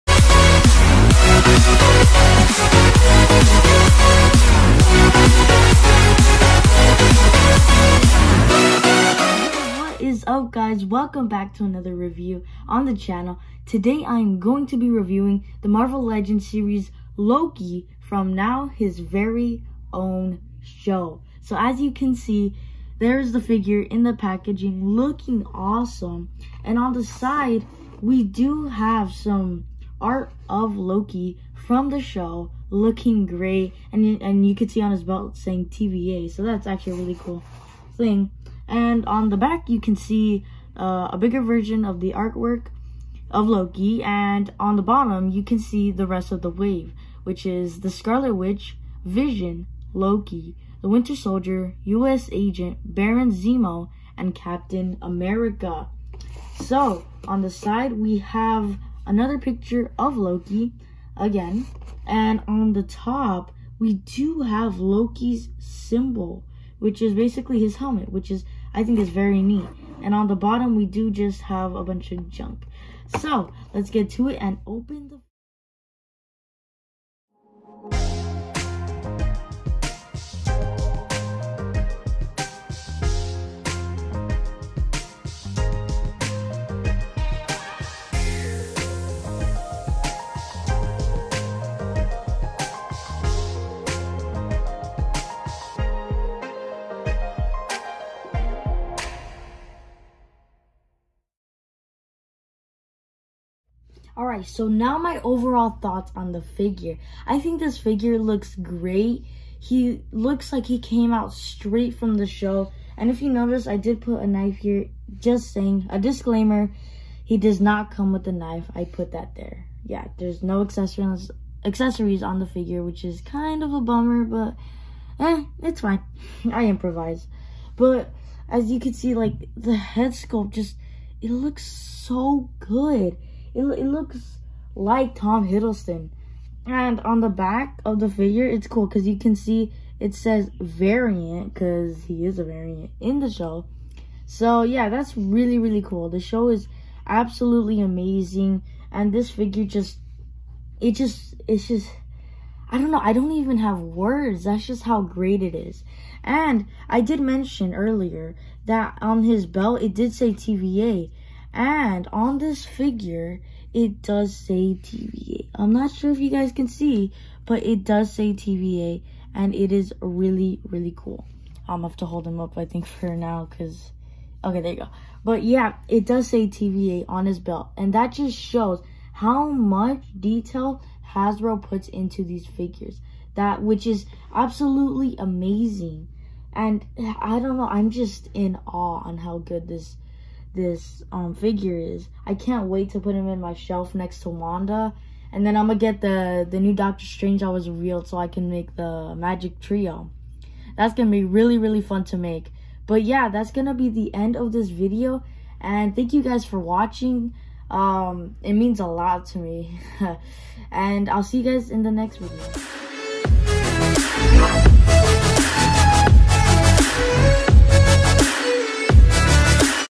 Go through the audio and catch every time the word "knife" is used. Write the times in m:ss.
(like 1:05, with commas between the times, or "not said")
1:54, 1:58.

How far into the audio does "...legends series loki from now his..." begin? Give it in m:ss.
0:16.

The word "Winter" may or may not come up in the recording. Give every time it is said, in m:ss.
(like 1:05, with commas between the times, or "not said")
0:50.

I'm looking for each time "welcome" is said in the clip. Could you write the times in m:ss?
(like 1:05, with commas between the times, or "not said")
0:10.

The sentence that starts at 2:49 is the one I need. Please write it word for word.
And it is really, really cool.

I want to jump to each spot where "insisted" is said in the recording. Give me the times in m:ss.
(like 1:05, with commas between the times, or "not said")
not said.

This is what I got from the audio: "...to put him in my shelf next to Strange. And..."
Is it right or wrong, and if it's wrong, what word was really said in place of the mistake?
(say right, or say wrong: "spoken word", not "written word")
wrong: "Wanda", not "Strange".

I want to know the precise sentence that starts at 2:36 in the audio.
And I did mention earlier that on his belt, it did say TVA.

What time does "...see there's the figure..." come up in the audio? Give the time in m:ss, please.
0:22.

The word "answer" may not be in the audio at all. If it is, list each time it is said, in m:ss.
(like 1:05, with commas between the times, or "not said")
not said.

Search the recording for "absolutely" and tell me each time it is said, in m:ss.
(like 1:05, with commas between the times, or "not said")
2:27, 3:04.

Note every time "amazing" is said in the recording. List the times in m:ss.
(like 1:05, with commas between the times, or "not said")
2:27, 3:05.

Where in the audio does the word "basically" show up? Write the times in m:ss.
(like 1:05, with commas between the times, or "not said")
1:07.